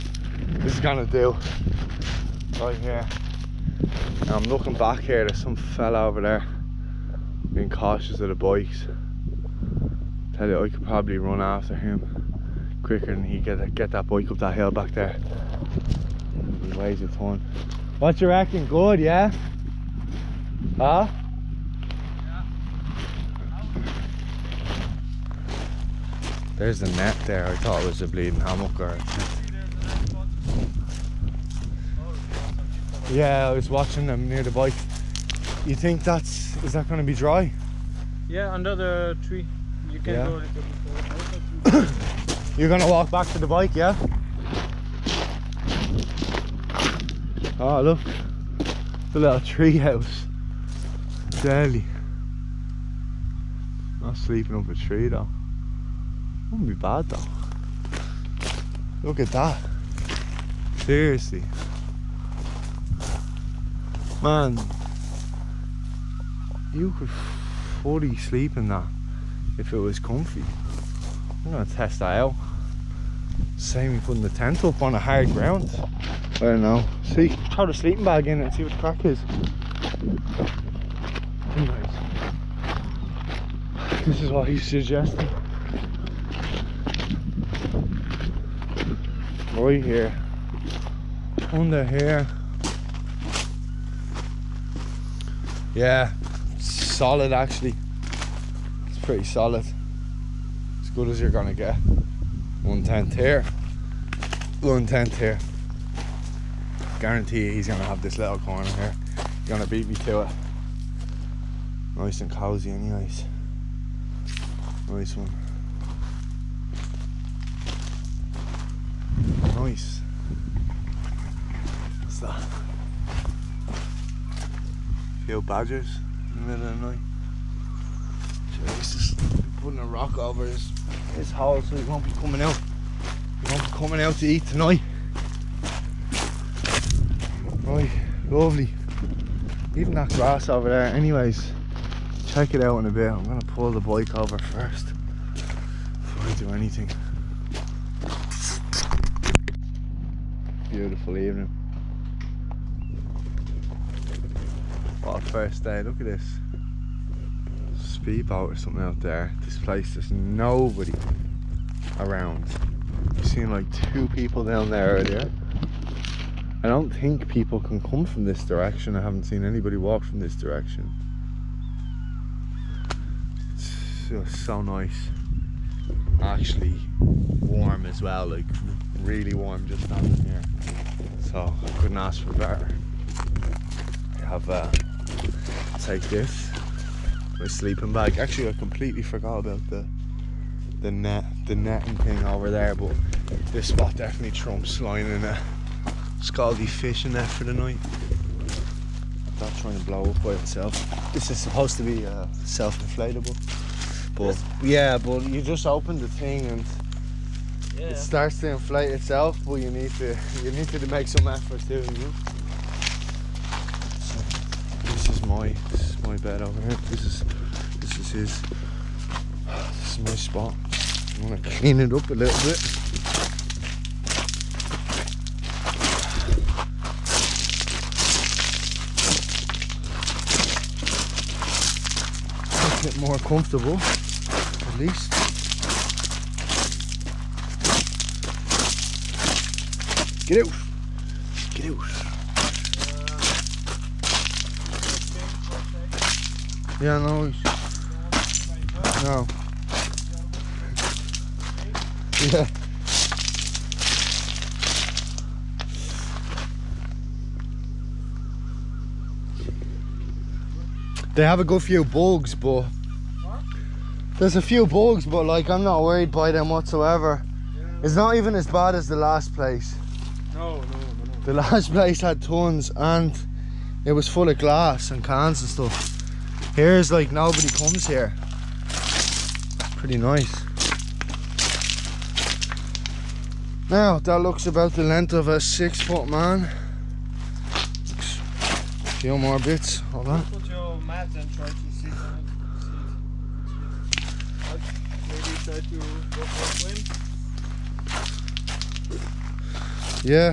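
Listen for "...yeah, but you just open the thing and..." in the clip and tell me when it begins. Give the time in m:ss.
3:24.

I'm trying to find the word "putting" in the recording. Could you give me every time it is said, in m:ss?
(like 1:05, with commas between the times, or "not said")
1:14, 2:09.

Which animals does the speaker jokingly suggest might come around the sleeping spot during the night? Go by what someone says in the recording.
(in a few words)
badgers.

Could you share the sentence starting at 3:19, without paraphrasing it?
i trying to blow up by itself.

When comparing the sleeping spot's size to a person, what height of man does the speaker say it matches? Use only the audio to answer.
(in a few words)
6 foot.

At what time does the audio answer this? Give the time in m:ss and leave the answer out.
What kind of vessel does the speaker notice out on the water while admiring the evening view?
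2:38.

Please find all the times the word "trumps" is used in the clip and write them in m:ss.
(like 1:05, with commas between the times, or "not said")
3:14.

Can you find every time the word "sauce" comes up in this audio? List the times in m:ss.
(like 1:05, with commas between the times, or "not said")
not said.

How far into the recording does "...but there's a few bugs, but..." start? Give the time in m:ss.
4:22.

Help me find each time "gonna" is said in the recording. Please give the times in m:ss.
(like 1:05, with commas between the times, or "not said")
0:00, 0:42, 1:11, 2:23, 3:41.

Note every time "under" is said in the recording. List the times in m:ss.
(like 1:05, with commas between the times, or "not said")
0:38, 1:31.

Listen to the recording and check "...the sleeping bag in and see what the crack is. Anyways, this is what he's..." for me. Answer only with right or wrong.
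right.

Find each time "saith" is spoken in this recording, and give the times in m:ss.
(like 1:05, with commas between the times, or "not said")
not said.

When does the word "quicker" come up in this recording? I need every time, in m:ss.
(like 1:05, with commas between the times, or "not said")
0:12.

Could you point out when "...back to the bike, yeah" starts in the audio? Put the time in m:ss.
0:43.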